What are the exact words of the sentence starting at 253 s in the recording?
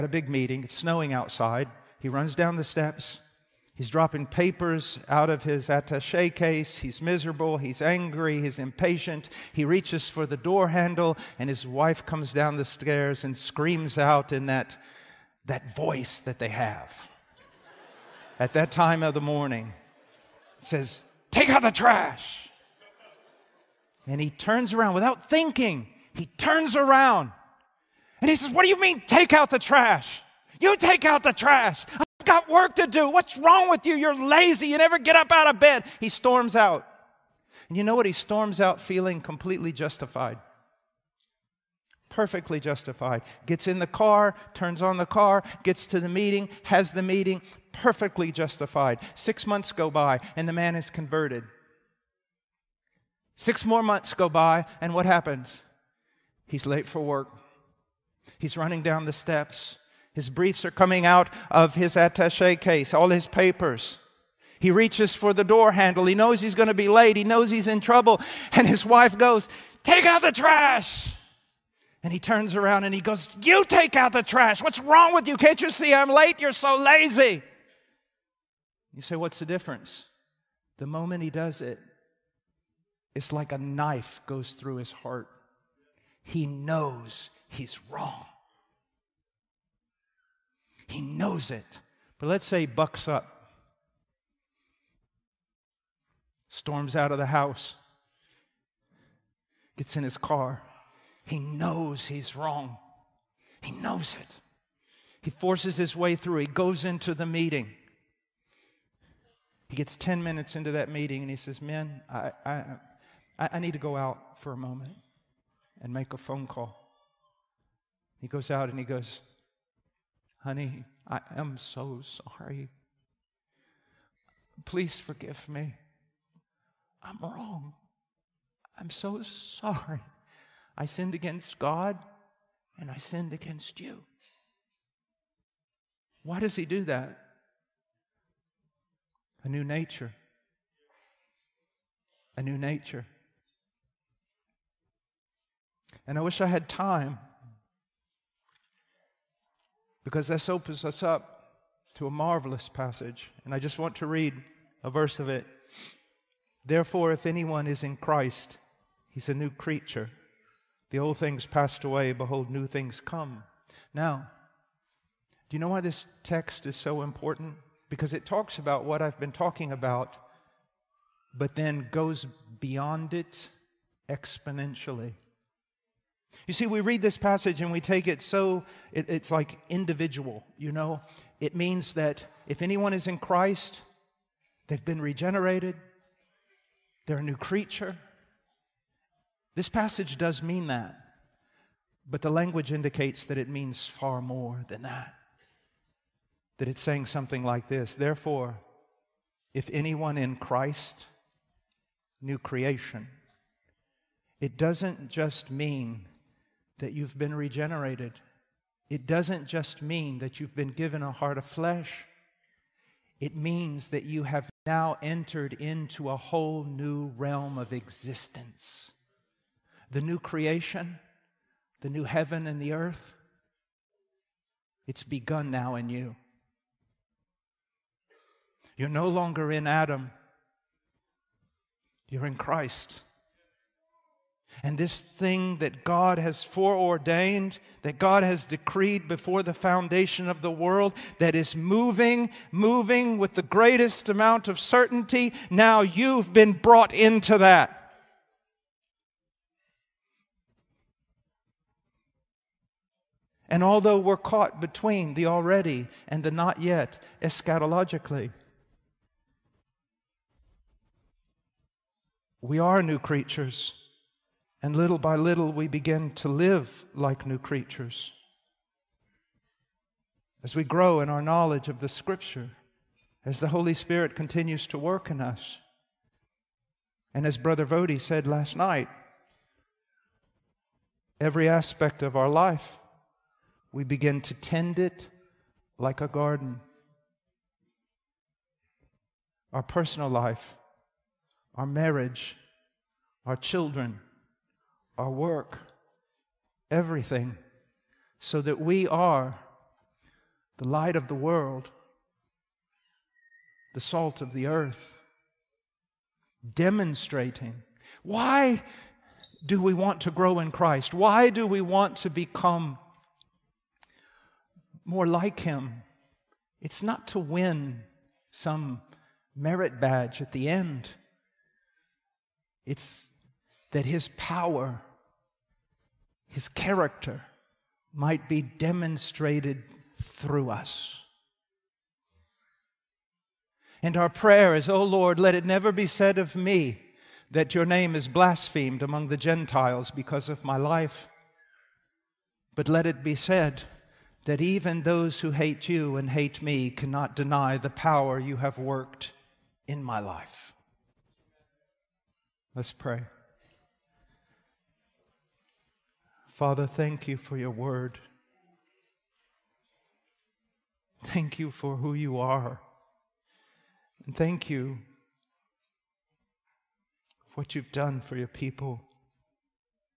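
And although we're caught between the already and the not yet, eschatologically, we are new creatures.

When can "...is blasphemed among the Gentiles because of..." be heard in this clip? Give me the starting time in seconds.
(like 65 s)
337 s.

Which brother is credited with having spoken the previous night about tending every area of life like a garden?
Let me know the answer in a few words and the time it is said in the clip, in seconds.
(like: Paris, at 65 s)
Brother Vodi, at 277 s.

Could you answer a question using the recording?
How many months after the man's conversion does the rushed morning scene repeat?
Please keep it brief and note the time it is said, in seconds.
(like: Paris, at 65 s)
6, at 53 s.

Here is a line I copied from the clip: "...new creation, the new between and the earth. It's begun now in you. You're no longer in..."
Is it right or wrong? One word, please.
wrong.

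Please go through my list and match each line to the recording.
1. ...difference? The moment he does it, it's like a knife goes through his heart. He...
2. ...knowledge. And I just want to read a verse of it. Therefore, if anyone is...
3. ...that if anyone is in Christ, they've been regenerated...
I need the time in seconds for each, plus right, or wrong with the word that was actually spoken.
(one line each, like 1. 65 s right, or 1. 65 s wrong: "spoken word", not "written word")
1. 79 s right
2. 152 s wrong: "passage", not "knowledge"
3. 181 s right.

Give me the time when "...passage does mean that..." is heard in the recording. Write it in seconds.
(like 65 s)
189 s.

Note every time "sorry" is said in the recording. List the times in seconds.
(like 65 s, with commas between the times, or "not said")
122 s, 129 s.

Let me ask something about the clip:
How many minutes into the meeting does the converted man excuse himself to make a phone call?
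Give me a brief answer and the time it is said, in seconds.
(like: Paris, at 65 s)
10, at 109 s.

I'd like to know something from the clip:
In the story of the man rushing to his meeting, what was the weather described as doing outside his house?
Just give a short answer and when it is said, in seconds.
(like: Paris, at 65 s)
Snowing, at 0 s.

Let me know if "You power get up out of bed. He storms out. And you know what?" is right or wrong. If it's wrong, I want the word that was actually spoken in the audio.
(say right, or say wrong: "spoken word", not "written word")
wrong: "never", not "power".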